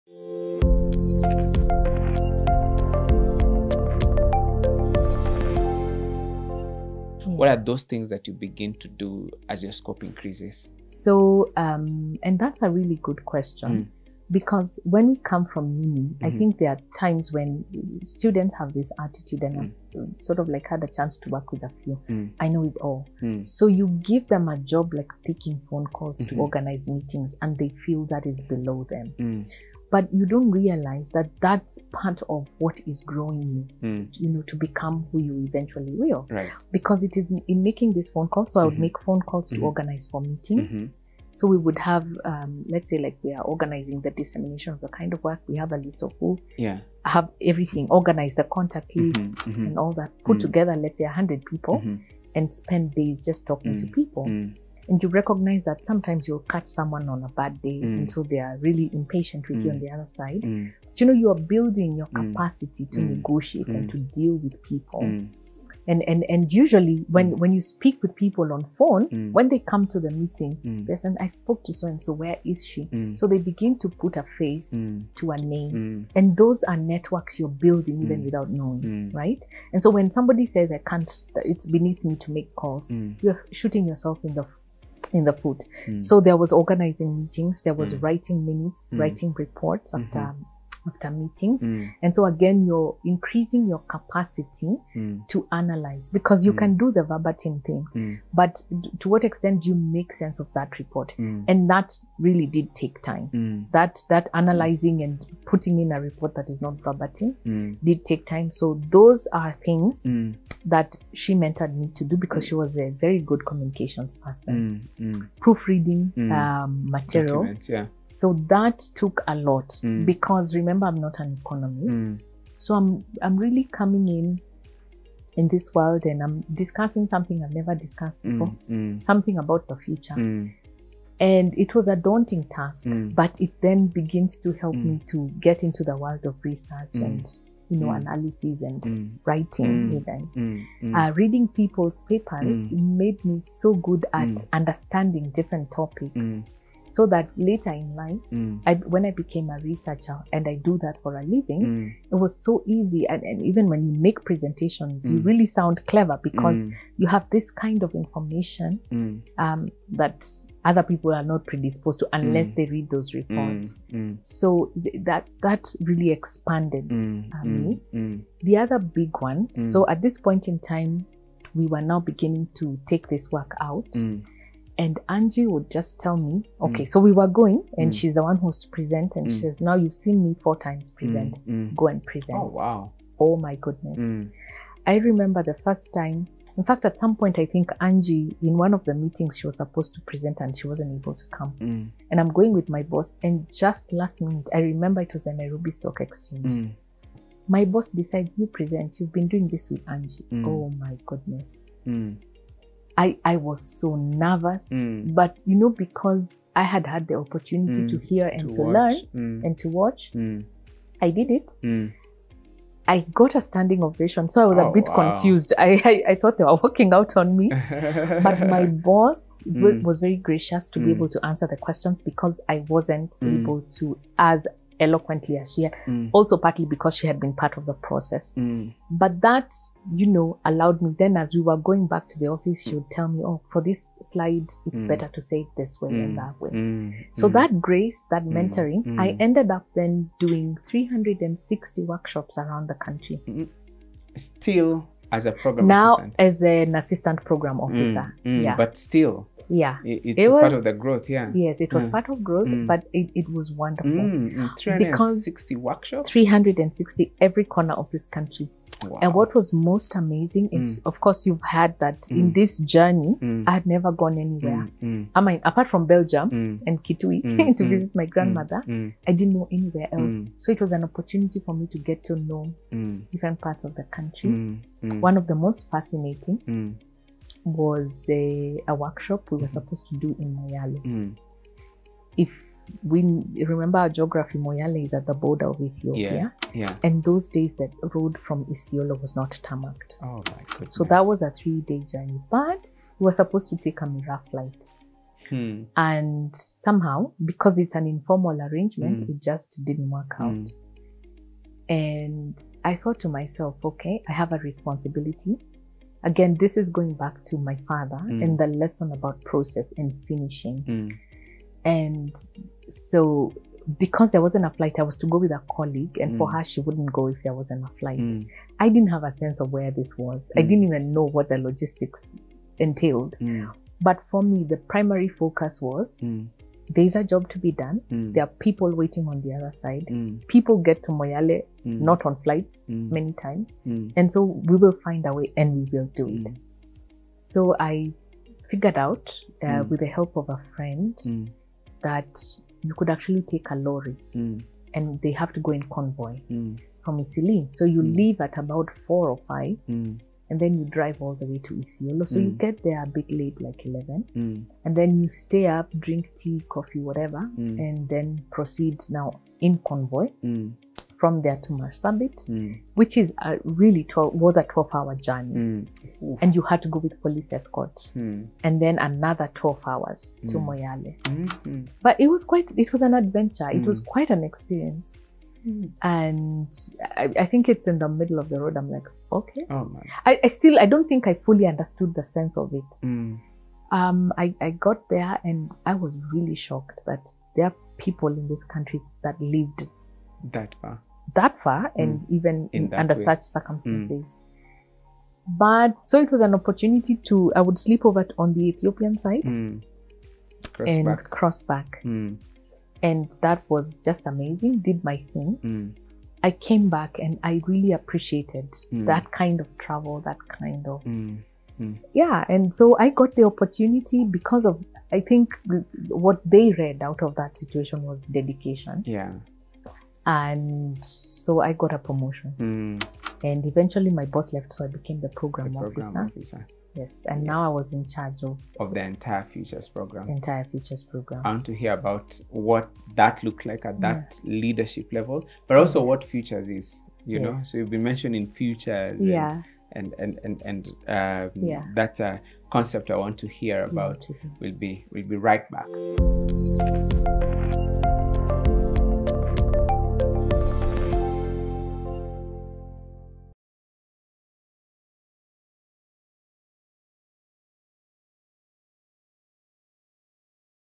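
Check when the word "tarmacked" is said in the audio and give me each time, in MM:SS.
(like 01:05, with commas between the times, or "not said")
04:49.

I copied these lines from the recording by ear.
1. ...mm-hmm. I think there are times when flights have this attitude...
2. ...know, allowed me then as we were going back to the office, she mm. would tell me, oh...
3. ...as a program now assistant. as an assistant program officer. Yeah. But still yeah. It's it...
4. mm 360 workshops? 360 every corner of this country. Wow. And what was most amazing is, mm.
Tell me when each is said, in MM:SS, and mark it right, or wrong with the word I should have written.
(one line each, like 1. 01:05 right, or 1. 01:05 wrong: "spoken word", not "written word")
1. 00:16 wrong: "students", not "flights"
2. 03:50 right
3. 04:05 right
4. 04:14 right.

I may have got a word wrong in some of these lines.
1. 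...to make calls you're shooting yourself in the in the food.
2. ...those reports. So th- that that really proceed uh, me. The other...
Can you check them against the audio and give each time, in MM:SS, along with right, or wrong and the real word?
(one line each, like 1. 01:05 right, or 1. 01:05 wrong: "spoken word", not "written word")
1. 01:22 right
2. 02:42 wrong: "expanded", not "proceed".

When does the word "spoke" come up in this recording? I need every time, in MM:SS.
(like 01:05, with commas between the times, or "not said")
01:11.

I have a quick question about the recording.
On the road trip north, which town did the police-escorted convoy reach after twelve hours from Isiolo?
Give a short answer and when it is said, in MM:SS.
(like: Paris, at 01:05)
Marsabit, at 06:01.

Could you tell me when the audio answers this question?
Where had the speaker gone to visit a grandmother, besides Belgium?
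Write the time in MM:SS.
04:26.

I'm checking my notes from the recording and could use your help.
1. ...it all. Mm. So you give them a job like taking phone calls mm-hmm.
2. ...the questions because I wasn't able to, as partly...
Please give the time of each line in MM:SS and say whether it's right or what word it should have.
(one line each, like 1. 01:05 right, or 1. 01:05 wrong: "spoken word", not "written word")
1. 00:22 right
2. 03:41 wrong: "eloquently", not "partly".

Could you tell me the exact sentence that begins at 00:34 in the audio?
you know to become who you eventually will right because it is in making these phone calls so mm-hmm.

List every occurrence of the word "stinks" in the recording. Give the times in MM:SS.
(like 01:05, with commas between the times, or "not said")
not said.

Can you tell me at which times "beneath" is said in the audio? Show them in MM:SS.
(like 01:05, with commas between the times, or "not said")
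01:21.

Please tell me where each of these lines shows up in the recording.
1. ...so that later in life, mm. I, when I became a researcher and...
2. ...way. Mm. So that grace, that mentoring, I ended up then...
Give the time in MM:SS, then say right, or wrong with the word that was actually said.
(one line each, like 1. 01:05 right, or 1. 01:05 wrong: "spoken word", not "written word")
1. 02:26 right
2. 03:56 right.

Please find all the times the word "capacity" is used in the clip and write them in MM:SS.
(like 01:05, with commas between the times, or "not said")
01:02, 01:33.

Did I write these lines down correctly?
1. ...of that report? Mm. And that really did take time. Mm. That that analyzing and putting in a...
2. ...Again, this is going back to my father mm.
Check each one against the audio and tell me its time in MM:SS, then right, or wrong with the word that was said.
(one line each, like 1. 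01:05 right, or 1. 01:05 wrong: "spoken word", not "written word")
1. 01:40 right
2. 05:06 right.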